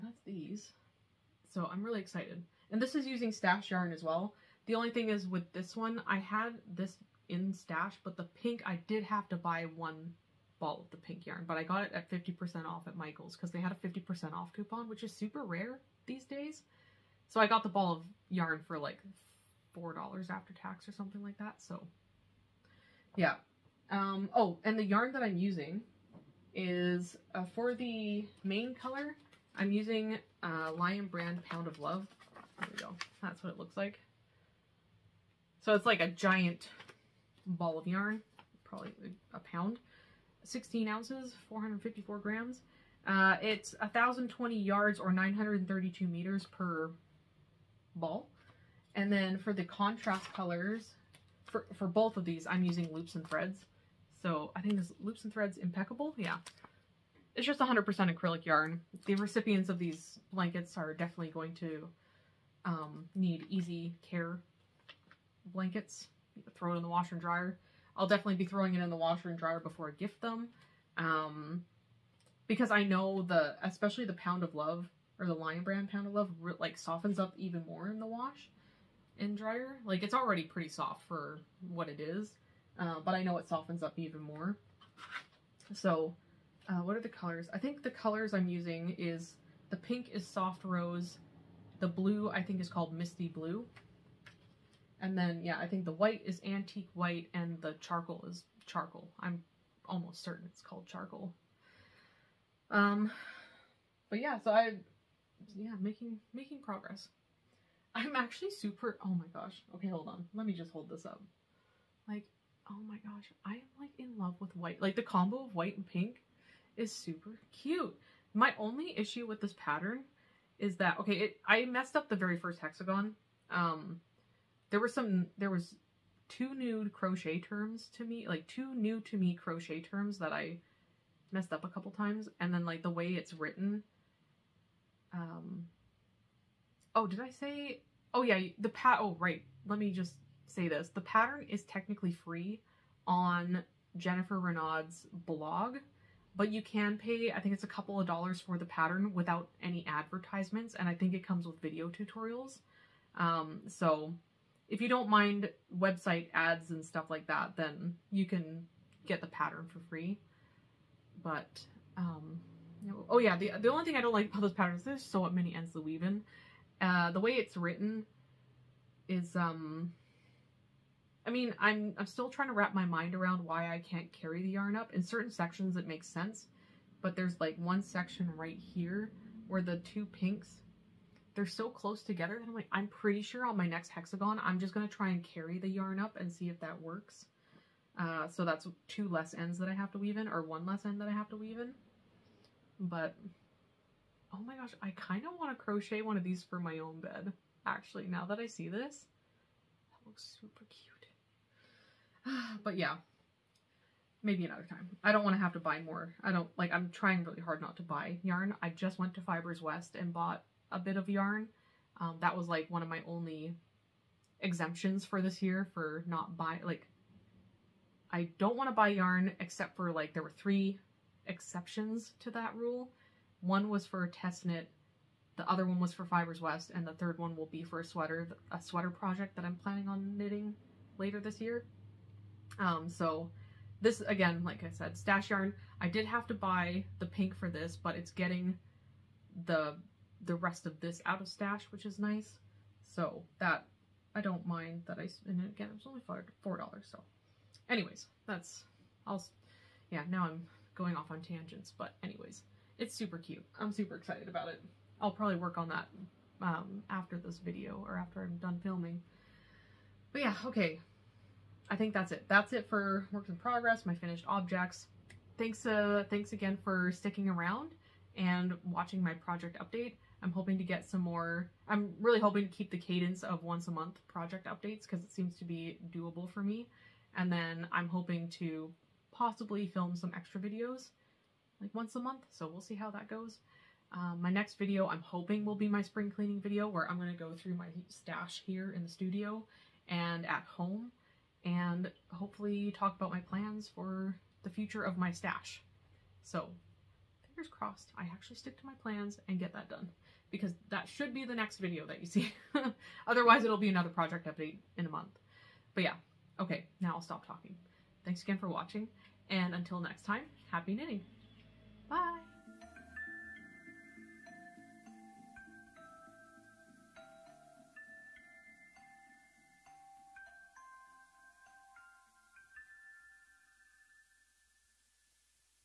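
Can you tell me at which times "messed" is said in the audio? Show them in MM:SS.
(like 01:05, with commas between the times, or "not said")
02:01, 02:11.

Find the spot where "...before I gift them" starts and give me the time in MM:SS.
01:09.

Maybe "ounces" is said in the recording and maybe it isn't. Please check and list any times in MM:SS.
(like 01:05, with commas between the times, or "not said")
00:40.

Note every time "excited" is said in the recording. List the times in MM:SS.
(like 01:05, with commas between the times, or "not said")
00:02, 04:13.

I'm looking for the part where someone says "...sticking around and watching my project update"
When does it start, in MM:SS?
04:26.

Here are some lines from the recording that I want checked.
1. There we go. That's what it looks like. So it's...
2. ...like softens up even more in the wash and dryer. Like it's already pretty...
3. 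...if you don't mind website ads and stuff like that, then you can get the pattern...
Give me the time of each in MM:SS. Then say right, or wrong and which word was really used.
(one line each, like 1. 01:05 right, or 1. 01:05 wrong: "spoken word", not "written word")
1. 00:32 right
2. 01:16 right
3. 02:34 right.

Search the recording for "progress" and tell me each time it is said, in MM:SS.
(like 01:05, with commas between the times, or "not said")
01:46, 04:23.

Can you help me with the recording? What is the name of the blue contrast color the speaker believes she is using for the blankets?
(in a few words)
Misty blue.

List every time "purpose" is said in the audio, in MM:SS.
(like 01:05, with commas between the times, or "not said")
not said.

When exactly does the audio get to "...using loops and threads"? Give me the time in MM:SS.
00:52.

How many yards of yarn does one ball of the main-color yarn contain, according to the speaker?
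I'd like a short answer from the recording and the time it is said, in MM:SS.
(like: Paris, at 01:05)
1,020 yards, at 00:43.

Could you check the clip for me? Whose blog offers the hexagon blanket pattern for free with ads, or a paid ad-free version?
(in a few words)
Jennifer Renaud.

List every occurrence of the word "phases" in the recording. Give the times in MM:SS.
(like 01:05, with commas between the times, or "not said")
not said.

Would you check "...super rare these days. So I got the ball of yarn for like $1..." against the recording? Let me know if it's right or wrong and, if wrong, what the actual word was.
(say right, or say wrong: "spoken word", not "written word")
wrong: "4", not "1".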